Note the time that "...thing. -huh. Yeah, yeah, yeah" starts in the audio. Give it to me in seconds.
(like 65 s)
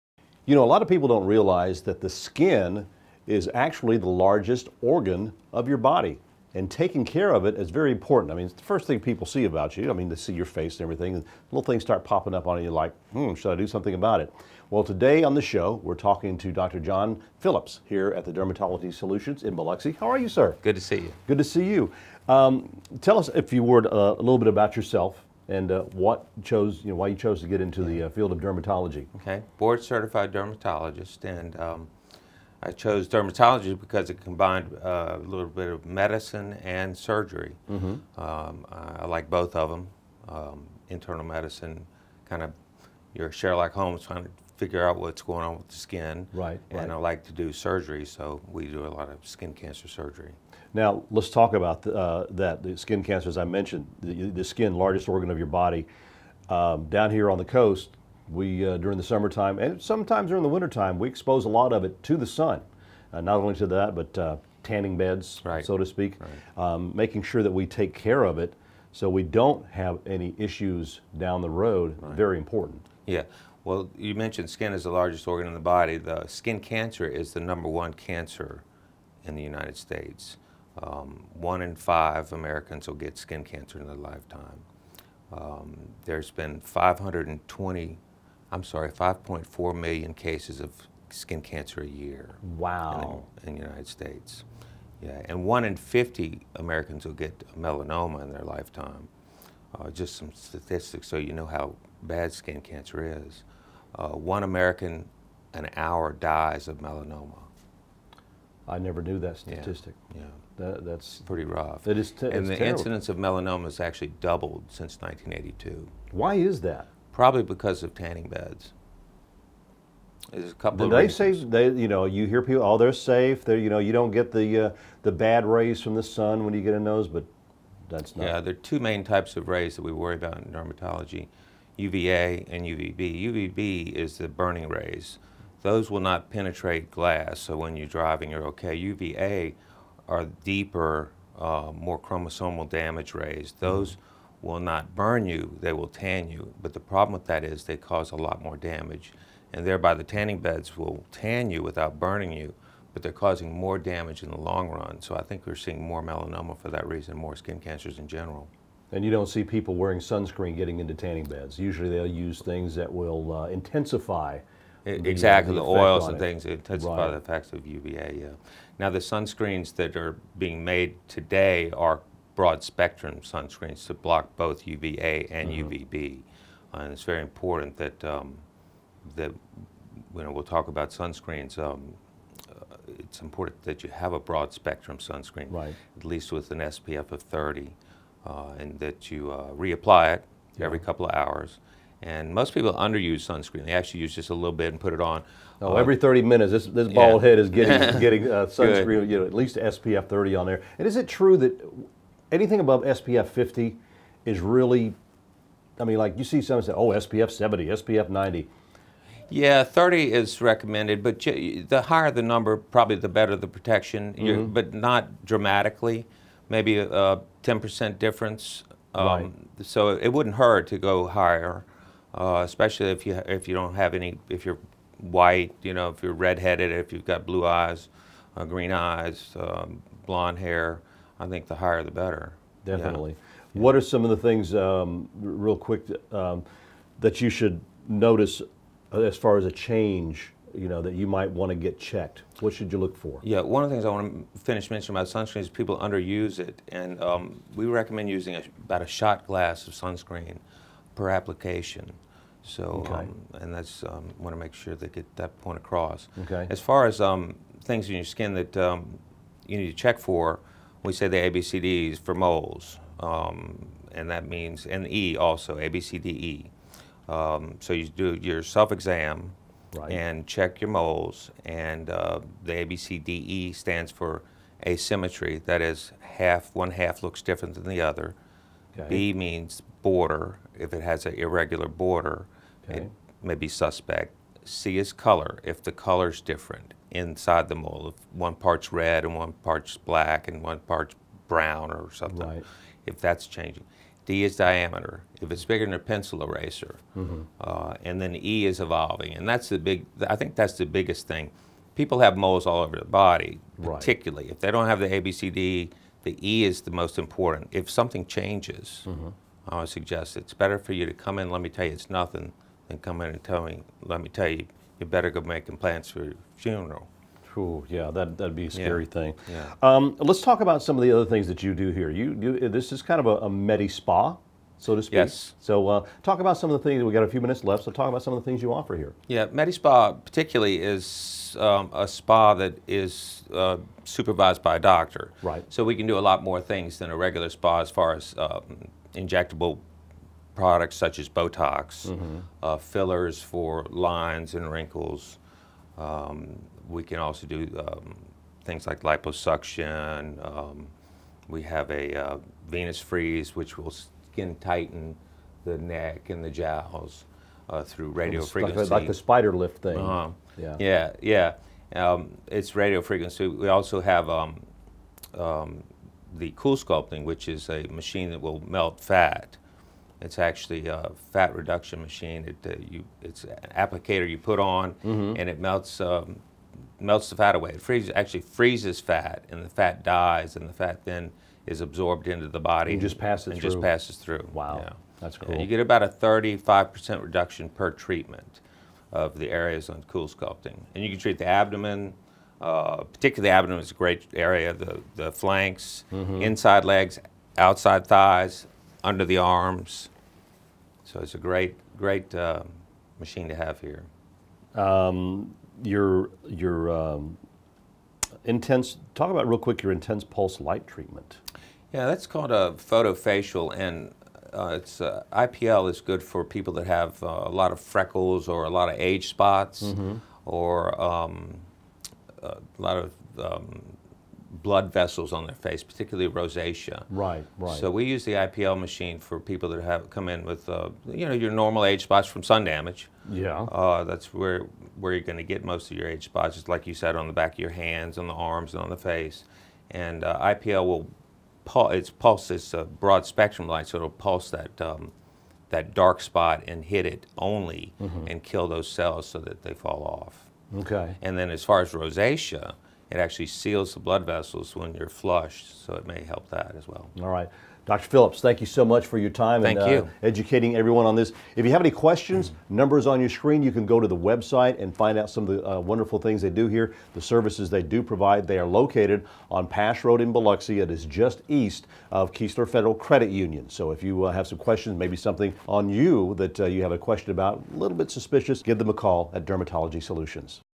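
359 s.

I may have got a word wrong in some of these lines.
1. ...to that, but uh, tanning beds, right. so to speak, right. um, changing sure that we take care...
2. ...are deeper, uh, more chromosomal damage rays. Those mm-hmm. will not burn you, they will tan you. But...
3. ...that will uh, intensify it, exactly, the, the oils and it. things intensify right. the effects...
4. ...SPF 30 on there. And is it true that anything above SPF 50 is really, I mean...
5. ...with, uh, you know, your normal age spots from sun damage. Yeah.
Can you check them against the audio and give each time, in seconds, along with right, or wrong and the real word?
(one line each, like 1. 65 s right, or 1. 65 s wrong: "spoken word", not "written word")
1. 63 s wrong: "making", not "changing"
2. 140 s right
3. 162 s right
4. 199 s right
5. 430 s right.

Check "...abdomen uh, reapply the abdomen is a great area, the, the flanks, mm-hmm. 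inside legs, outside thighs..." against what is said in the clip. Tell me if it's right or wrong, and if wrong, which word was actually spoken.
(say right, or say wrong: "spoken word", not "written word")
wrong: "particularly", not "reapply".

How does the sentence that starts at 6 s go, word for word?
And taking care of it is very important.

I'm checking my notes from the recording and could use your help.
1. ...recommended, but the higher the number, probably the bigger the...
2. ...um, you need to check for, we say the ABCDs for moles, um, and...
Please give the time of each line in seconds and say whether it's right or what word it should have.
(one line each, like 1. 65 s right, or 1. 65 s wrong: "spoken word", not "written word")
1. 210 s wrong: "better", not "bigger"
2. 258 s right.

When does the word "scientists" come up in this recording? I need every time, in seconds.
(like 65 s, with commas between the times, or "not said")
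not said.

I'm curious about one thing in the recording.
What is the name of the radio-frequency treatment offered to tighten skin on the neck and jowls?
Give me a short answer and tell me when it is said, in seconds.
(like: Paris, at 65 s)
Venus Freeze, at 352 s.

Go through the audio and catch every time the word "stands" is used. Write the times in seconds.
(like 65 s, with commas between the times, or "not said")
273 s.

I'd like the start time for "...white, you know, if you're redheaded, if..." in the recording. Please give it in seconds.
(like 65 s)
224 s.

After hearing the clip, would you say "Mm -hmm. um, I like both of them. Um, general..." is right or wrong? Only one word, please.
wrong.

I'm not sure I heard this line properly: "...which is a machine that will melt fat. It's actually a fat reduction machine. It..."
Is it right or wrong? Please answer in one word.
right.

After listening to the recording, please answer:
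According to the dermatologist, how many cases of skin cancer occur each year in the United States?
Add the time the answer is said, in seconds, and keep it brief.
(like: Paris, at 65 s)
5.4 million, at 88 s.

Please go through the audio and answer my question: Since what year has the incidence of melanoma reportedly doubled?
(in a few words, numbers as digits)
1982.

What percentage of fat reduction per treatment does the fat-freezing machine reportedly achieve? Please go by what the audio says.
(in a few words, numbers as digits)
35%.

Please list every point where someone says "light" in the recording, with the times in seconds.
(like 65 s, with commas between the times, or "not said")
410 s, 443 s.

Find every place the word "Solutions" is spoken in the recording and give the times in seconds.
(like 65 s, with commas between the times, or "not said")
18 s, 479 s.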